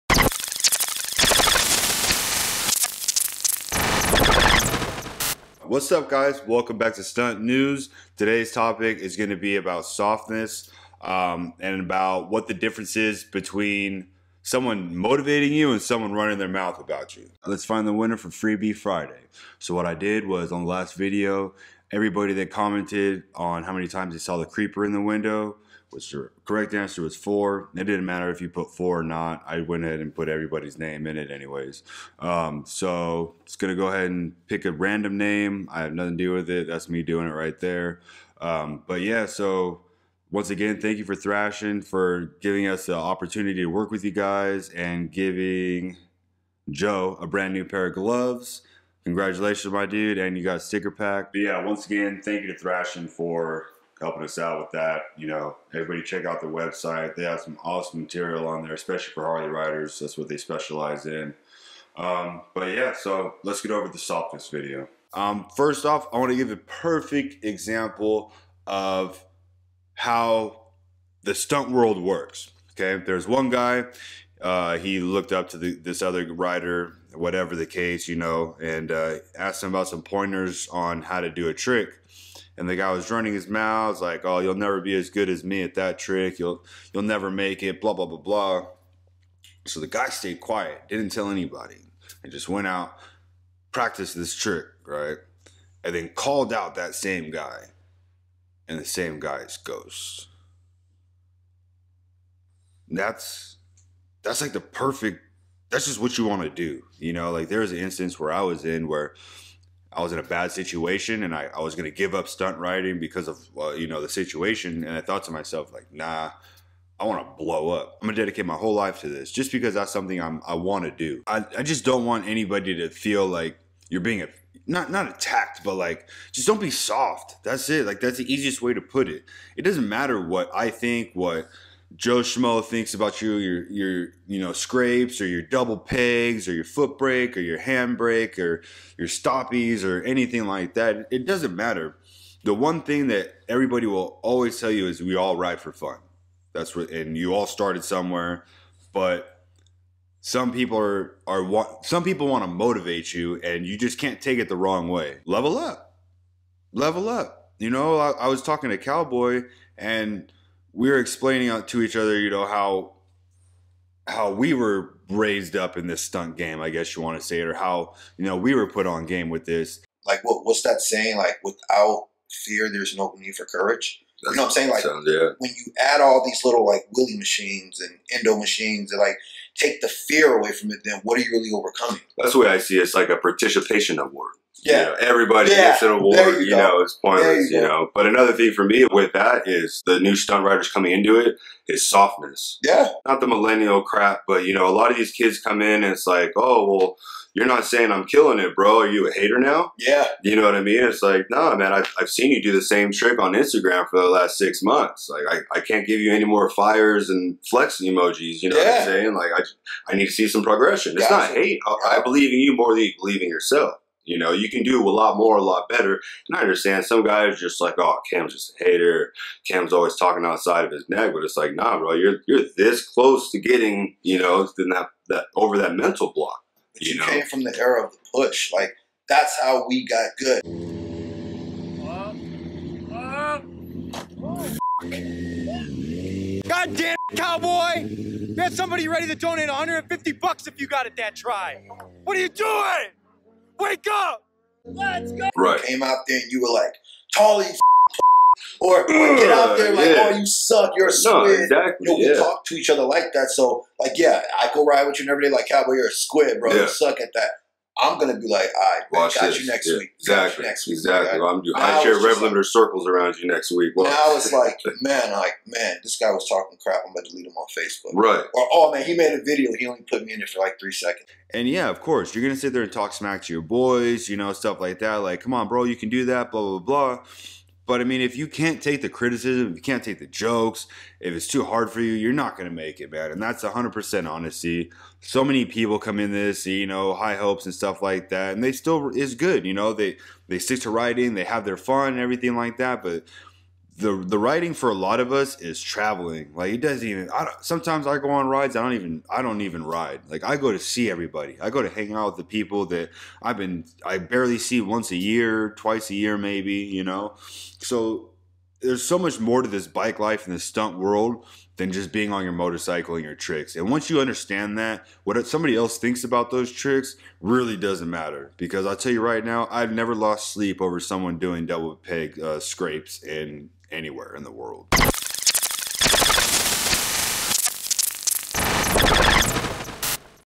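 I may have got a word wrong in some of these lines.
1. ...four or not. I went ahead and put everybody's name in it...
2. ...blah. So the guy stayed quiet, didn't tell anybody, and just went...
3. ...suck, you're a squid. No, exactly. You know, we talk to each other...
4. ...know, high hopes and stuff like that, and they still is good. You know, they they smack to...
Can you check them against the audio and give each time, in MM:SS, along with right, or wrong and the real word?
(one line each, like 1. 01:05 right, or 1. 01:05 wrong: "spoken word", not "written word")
1. 00:28 right
2. 01:28 right
3. 04:10 right
4. 04:46 wrong: "stick", not "smack".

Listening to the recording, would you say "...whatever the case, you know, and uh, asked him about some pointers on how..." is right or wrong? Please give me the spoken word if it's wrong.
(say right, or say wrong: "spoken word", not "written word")
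right.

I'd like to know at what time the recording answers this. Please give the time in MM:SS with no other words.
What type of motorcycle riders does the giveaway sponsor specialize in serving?
00:59.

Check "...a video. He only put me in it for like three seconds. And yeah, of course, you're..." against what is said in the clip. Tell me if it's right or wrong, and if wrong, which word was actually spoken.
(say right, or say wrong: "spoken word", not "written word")
right.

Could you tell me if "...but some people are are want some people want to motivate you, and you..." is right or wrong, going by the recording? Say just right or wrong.
right.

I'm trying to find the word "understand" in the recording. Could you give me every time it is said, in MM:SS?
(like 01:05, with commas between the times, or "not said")
03:36, 05:13.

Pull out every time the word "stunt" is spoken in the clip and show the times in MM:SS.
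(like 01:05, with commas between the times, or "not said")
00:07, 01:11, 01:52, 02:46, 03:10, 05:10.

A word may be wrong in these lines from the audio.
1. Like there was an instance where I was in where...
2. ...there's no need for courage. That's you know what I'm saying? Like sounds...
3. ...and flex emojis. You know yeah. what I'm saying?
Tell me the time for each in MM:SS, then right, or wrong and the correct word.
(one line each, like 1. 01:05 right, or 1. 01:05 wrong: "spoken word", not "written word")
1. 01:47 right
2. 02:52 right
3. 03:27 right.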